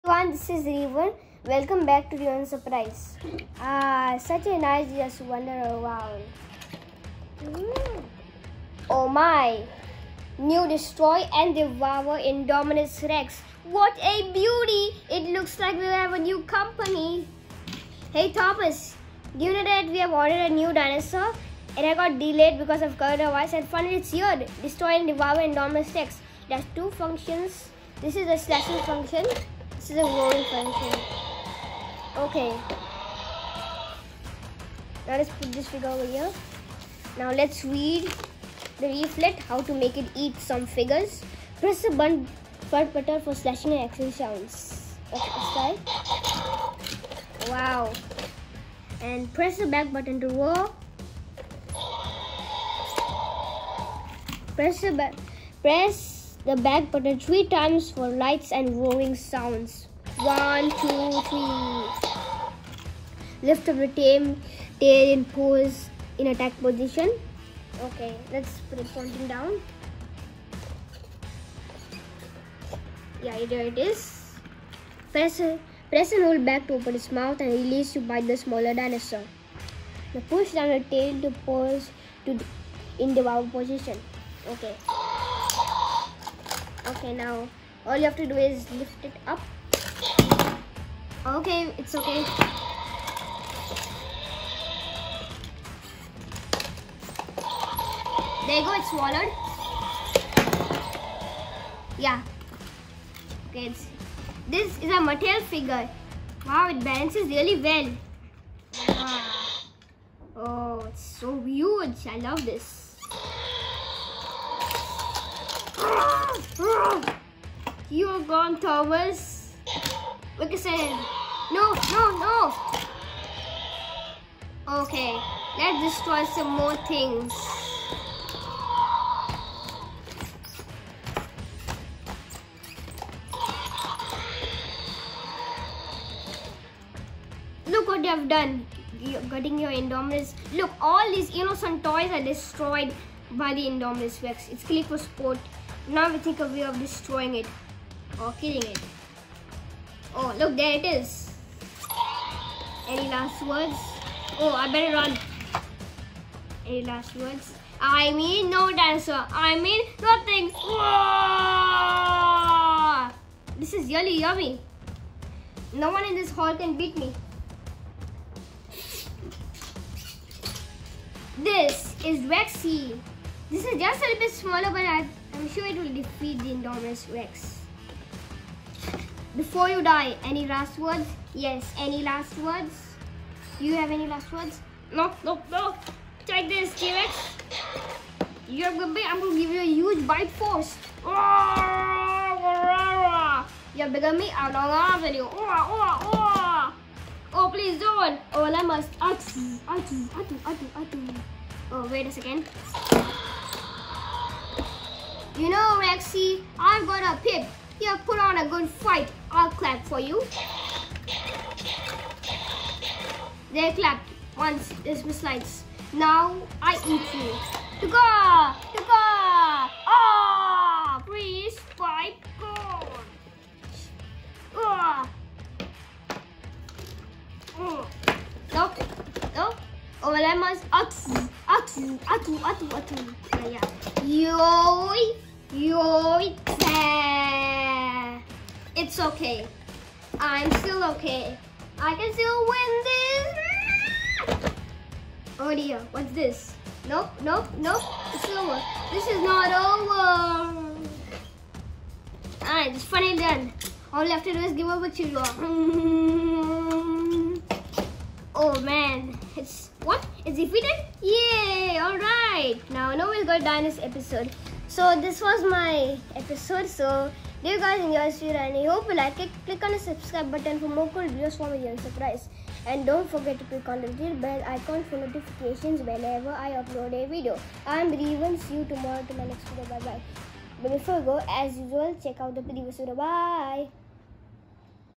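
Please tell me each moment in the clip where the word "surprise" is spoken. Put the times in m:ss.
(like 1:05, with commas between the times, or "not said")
0:02, 4:31.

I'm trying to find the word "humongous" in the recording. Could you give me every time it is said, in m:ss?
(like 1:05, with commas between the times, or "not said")
not said.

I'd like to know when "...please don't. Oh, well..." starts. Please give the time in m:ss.
3:17.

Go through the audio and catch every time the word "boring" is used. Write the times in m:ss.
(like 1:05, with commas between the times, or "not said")
not said.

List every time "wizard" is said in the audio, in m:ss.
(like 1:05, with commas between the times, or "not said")
not said.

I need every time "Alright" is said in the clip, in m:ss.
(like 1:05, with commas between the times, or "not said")
4:12, 4:21.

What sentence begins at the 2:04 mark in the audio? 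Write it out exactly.
Okay, let's destroy some more things.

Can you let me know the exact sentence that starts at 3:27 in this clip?
Here, put on a good fight.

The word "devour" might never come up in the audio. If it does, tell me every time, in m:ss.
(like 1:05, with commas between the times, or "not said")
0:11, 0:25.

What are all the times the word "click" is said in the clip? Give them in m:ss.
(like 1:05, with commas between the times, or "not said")
4:29, 4:33.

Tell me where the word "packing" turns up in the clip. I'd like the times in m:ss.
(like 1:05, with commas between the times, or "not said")
not said.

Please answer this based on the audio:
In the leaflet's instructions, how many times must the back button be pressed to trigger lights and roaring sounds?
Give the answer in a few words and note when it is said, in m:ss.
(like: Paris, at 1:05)
3, at 0:57.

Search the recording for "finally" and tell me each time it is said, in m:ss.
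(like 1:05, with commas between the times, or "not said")
0:23, 4:12.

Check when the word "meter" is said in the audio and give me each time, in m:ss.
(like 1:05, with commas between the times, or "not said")
not said.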